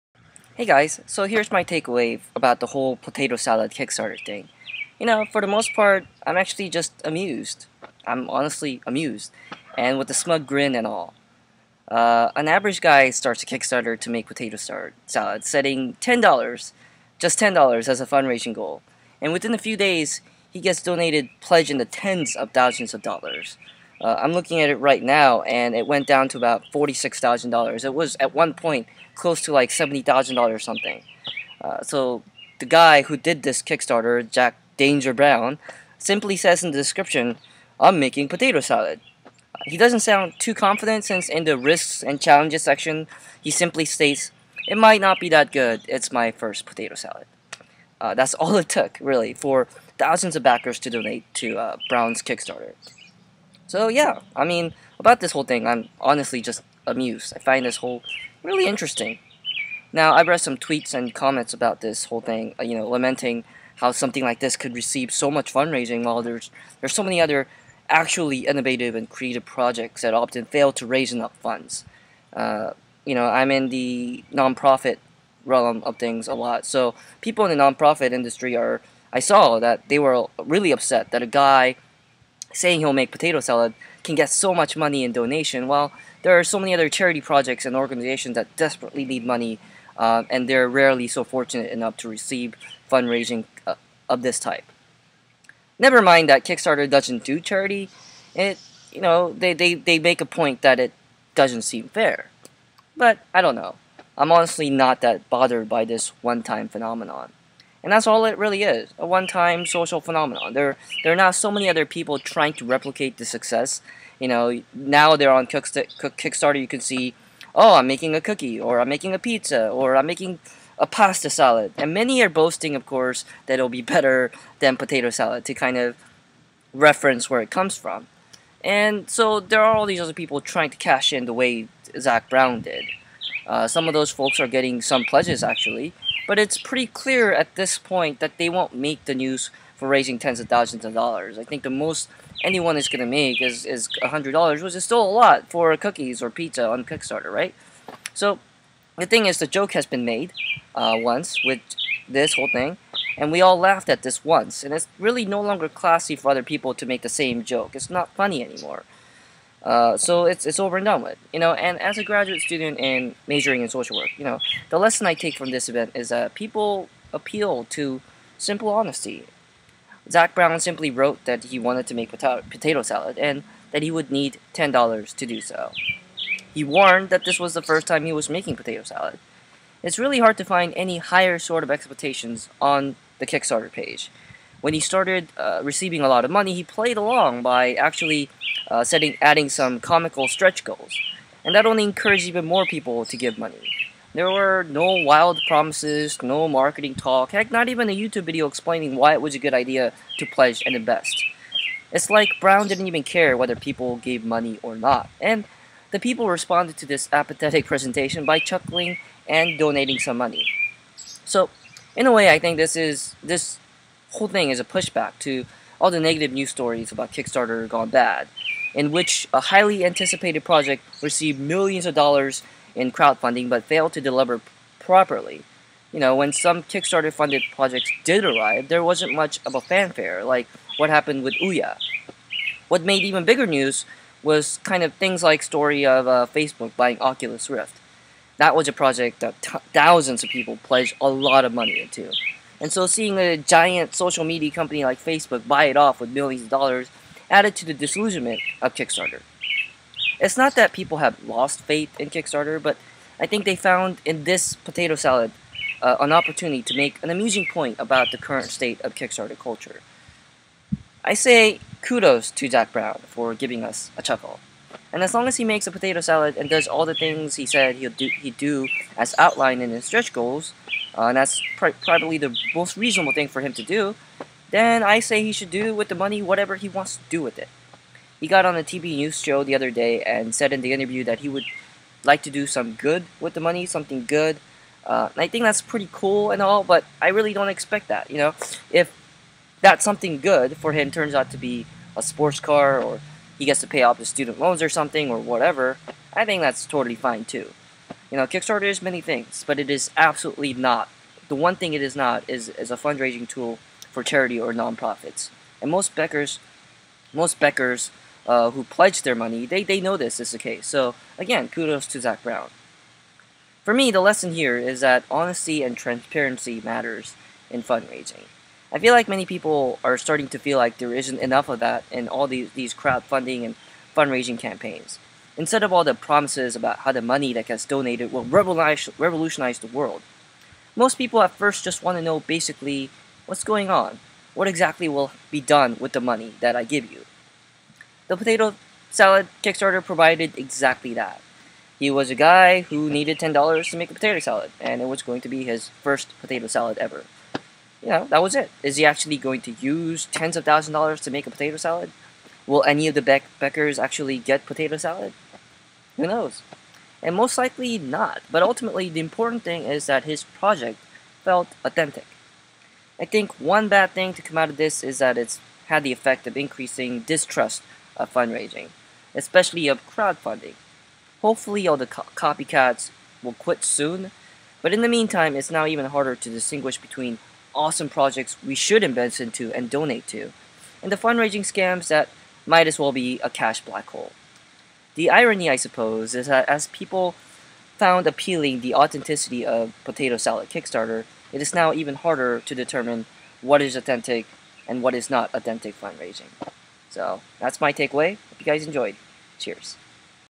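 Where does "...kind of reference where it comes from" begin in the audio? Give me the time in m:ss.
2:05.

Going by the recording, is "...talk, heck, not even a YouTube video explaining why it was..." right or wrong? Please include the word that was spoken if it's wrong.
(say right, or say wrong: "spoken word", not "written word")
right.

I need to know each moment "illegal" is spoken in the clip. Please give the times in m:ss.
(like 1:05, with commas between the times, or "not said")
not said.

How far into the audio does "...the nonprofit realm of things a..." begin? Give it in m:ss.
1:13.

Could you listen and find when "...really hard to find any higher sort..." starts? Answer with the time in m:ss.
2:59.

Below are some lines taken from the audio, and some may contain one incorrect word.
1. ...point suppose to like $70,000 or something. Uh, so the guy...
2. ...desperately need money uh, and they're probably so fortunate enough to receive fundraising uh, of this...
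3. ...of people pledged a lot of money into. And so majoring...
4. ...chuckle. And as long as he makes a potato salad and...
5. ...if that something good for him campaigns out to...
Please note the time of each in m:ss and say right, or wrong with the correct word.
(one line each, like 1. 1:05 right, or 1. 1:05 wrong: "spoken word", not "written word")
1. 0:28 wrong: "close", not "suppose"
2. 1:28 wrong: "rarely", not "probably"
3. 4:00 wrong: "seeing", not "majoring"
4. 4:24 right
5. 4:48 wrong: "turns", not "campaigns".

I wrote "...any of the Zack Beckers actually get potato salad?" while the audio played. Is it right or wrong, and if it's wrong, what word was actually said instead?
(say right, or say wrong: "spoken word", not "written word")
wrong: "Beck", not "Zack".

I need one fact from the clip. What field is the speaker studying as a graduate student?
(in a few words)
Social work.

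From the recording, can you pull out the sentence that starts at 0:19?
And within a few days, he gets donated pledge in the tens of thousands of dollars.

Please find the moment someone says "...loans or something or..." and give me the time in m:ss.
4:54.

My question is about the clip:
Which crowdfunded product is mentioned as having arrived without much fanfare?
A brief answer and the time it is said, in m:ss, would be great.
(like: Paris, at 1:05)
Ouya, at 3:51.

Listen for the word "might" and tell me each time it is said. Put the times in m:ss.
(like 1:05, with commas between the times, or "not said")
0:44, 6:22.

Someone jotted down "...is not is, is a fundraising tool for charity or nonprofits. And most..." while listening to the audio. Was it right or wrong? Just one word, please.
right.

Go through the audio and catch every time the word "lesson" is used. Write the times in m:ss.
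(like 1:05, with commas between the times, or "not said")
2:44, 5:13.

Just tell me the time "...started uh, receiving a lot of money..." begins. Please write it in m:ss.
3:04.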